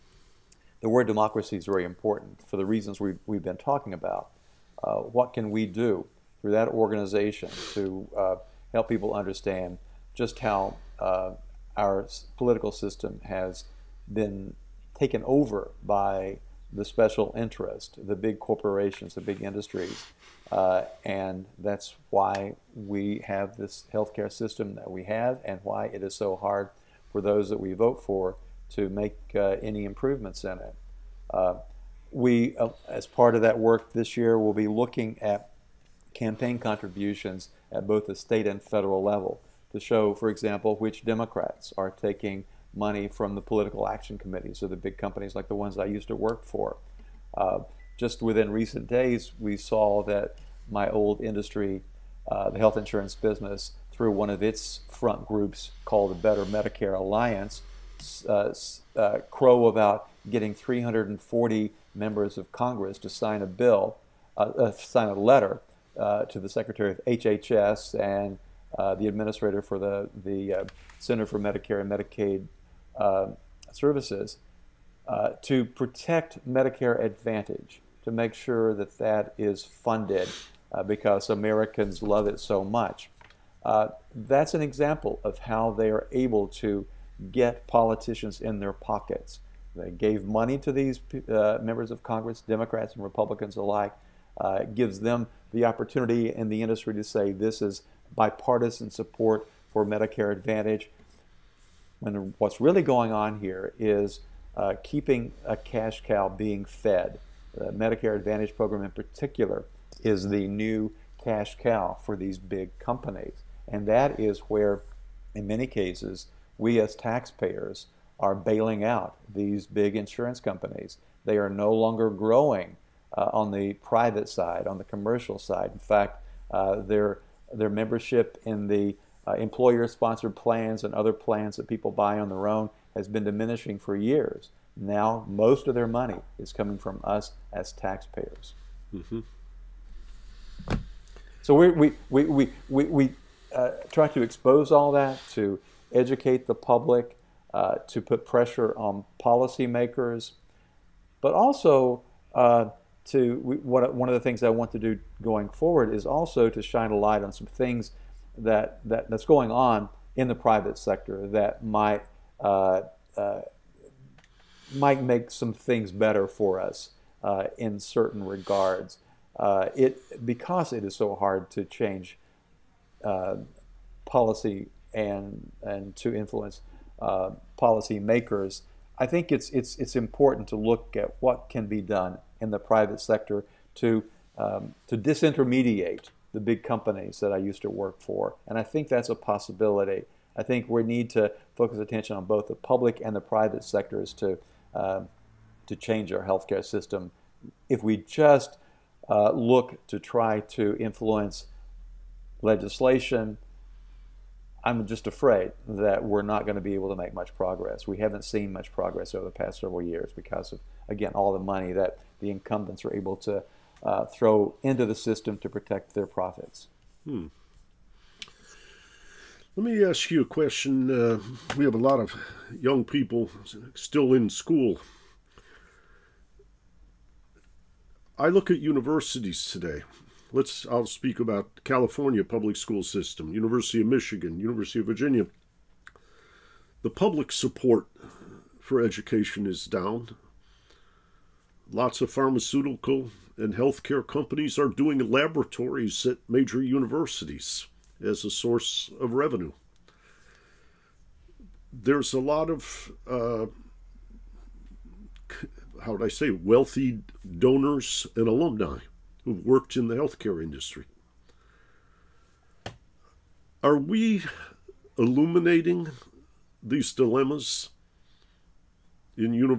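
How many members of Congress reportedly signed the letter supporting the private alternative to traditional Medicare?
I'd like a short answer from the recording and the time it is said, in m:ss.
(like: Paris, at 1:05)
340, at 1:00.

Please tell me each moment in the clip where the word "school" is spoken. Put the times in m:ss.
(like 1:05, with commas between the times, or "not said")
3:44, 3:52.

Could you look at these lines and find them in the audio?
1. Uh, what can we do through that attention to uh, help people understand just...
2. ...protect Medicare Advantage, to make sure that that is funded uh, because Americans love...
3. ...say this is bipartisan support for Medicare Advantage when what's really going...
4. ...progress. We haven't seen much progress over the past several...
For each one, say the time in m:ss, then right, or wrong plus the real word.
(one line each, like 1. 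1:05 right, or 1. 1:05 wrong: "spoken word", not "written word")
1. 0:04 wrong: "organization", not "attention"
2. 1:15 right
3. 1:37 right
4. 3:27 right.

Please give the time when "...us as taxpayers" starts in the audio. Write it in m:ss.
2:17.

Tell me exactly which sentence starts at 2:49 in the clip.
Uh, it because it is so hard to change uh, policy and and to influence uh, policy makers.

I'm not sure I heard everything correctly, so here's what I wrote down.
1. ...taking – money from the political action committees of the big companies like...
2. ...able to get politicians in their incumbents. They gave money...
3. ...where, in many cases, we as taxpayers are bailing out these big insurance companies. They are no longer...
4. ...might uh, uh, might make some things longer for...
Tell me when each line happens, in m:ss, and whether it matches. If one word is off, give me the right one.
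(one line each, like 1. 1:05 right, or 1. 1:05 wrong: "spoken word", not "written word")
1. 0:41 right
2. 1:26 wrong: "pockets", not "incumbents"
3. 1:54 right
4. 2:41 wrong: "better", not "longer".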